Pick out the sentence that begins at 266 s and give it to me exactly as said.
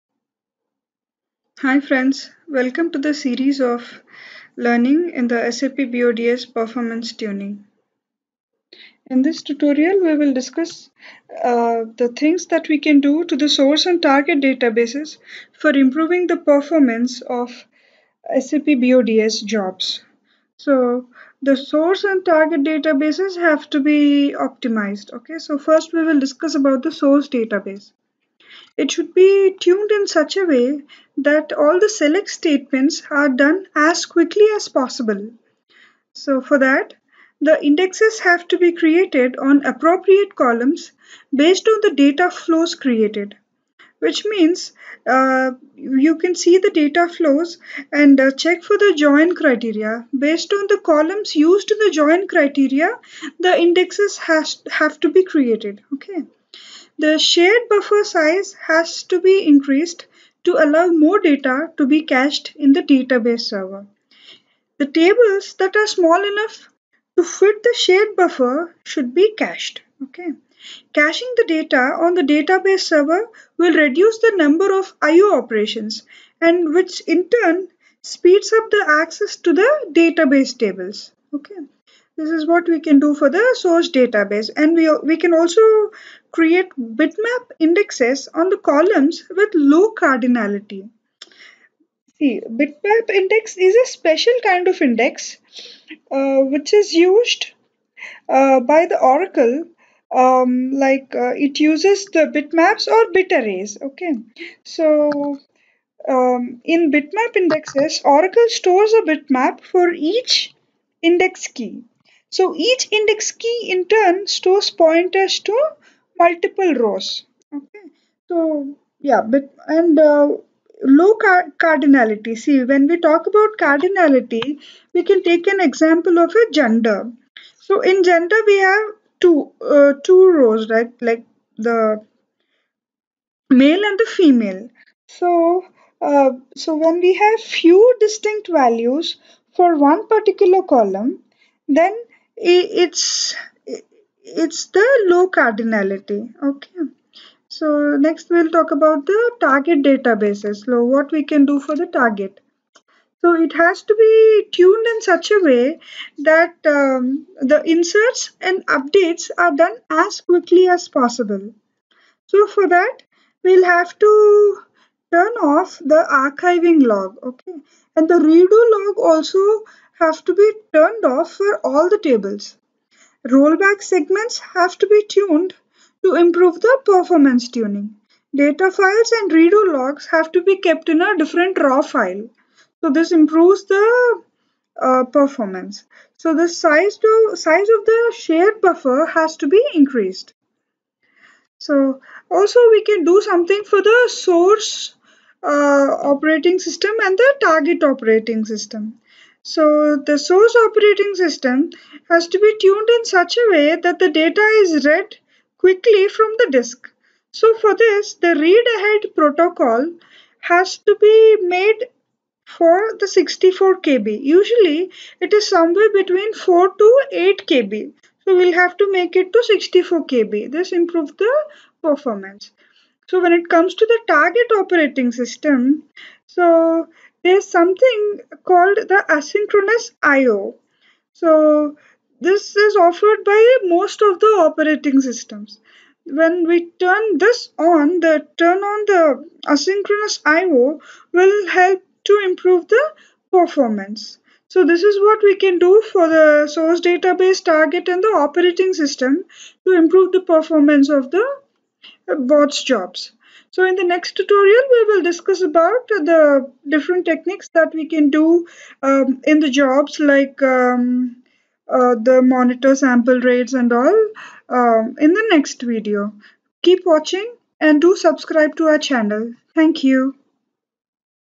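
Keep watching and do subscribe to our channel.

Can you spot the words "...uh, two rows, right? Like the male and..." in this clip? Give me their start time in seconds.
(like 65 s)
129 s.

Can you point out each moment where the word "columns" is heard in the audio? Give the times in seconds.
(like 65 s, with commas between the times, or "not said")
40 s, 50 s, 88 s, 140 s.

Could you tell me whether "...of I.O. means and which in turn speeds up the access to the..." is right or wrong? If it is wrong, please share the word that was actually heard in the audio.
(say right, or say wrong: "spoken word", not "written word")
wrong: "operations", not "means".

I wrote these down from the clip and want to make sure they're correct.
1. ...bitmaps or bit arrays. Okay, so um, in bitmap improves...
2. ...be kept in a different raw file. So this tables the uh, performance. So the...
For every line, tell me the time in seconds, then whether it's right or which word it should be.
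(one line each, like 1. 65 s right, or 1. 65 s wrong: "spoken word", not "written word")
1. 102 s wrong: "indexes", not "improves"
2. 180 s wrong: "improves", not "tables".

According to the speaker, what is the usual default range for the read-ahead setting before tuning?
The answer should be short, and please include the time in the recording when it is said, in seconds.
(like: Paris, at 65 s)
4 to 8 KB, at 216 s.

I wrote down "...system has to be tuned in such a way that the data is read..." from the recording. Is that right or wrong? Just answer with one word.
right.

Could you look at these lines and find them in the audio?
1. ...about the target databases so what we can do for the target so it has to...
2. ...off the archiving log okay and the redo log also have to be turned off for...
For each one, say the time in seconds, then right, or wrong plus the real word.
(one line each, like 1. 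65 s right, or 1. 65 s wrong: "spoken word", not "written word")
1. 148 s right
2. 165 s right.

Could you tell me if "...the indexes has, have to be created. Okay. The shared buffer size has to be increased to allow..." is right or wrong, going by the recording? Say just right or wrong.
right.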